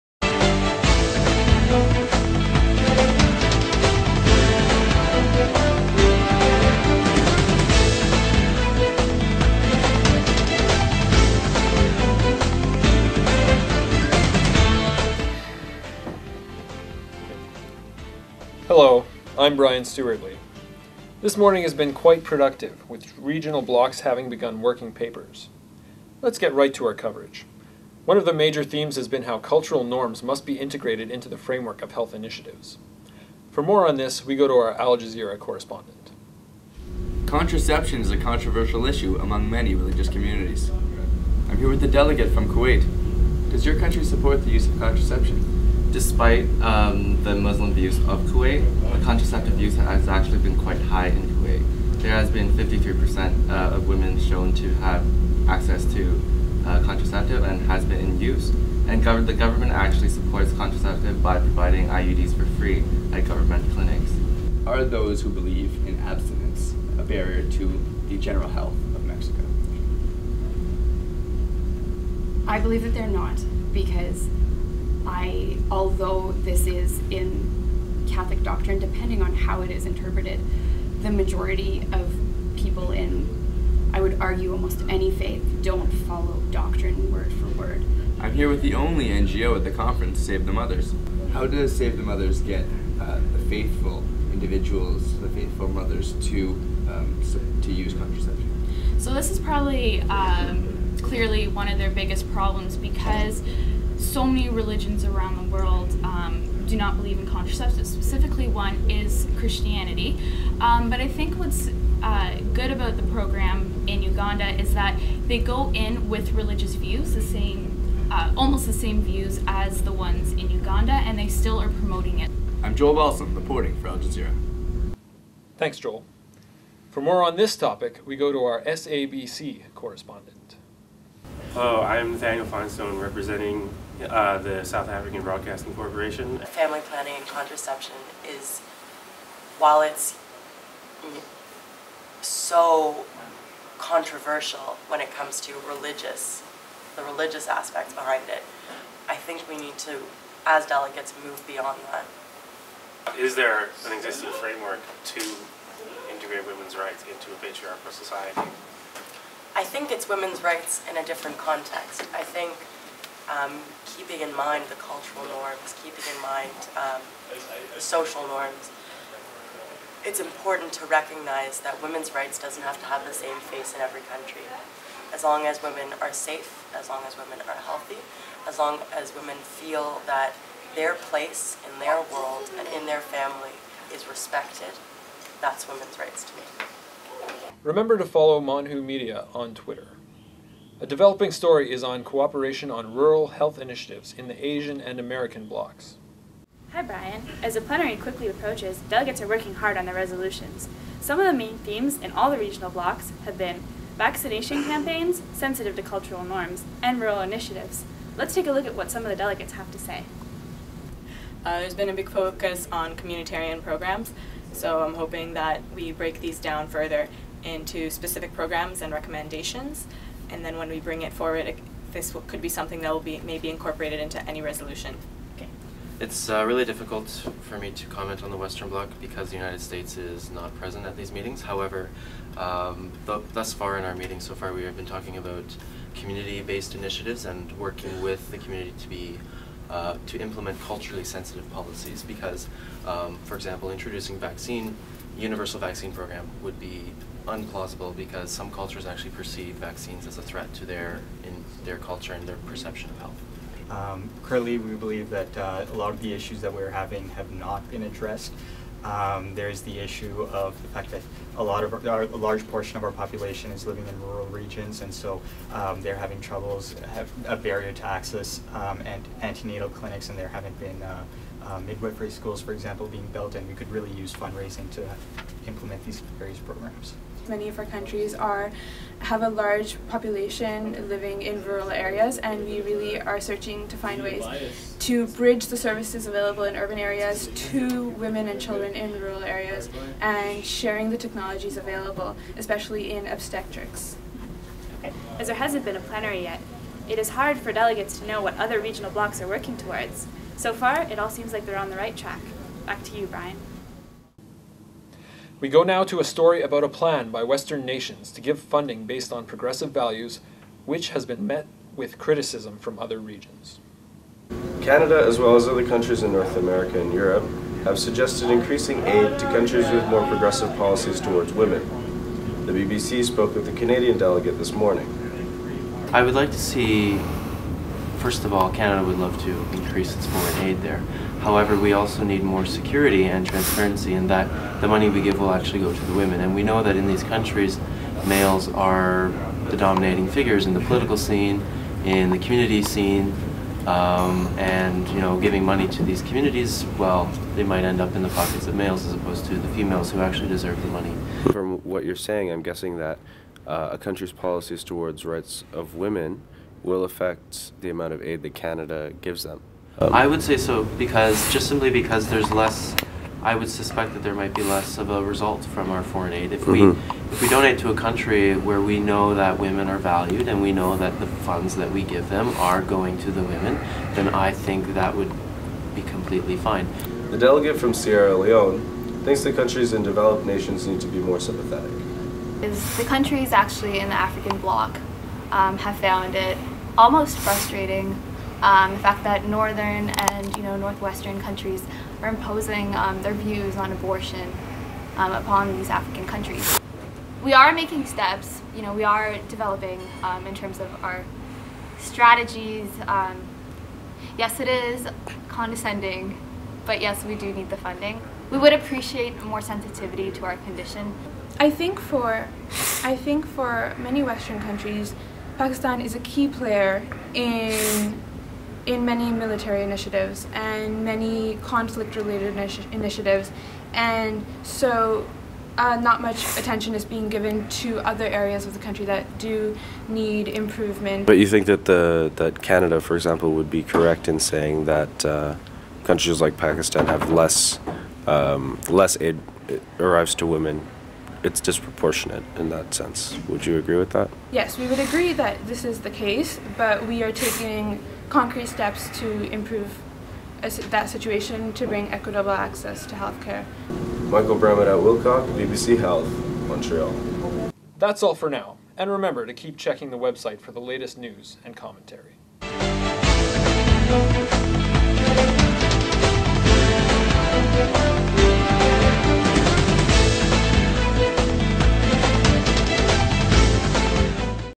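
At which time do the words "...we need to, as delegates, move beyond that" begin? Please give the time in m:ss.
2:29.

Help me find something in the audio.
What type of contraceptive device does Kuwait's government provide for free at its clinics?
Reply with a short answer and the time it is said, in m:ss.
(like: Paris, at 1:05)
IUDs, at 1:01.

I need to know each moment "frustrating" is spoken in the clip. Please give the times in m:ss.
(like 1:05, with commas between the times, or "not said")
6:27.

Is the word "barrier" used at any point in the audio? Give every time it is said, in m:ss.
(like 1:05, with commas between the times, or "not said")
1:07, 4:27.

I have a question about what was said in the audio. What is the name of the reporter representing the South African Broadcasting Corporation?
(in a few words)
Nathaniel Finestone.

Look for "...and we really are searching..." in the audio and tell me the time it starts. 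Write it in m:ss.
4:42.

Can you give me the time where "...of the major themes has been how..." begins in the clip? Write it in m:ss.
0:28.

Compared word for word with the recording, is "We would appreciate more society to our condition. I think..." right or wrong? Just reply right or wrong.
wrong.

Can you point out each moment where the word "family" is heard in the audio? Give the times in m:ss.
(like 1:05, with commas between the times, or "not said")
2:16, 3:03.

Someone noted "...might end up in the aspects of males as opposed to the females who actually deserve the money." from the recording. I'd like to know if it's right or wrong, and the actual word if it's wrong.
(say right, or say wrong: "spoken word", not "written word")
wrong: "pockets", not "aspects".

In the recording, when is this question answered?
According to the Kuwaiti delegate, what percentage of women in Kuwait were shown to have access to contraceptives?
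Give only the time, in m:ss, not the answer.
0:52.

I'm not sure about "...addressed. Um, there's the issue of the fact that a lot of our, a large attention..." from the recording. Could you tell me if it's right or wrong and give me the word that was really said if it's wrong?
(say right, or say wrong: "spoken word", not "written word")
wrong: "portion", not "attention".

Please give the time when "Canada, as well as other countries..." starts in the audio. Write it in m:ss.
5:14.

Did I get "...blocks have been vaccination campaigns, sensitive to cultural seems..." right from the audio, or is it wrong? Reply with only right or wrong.
wrong.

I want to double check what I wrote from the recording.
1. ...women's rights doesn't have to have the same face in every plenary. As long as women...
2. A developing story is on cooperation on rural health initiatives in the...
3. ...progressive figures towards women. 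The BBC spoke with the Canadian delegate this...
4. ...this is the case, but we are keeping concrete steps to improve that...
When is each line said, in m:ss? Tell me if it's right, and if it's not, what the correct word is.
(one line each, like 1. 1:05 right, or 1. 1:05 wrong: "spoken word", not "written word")
1. 2:51 wrong: "country", not "plenary"
2. 3:10 right
3. 5:20 wrong: "policies", not "figures"
4. 7:25 wrong: "taking", not "keeping".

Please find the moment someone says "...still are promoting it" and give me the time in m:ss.
2:01.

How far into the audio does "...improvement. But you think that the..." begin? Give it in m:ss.
7:10.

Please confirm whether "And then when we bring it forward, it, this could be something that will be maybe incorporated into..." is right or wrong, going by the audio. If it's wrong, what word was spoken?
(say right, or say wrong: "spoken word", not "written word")
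right.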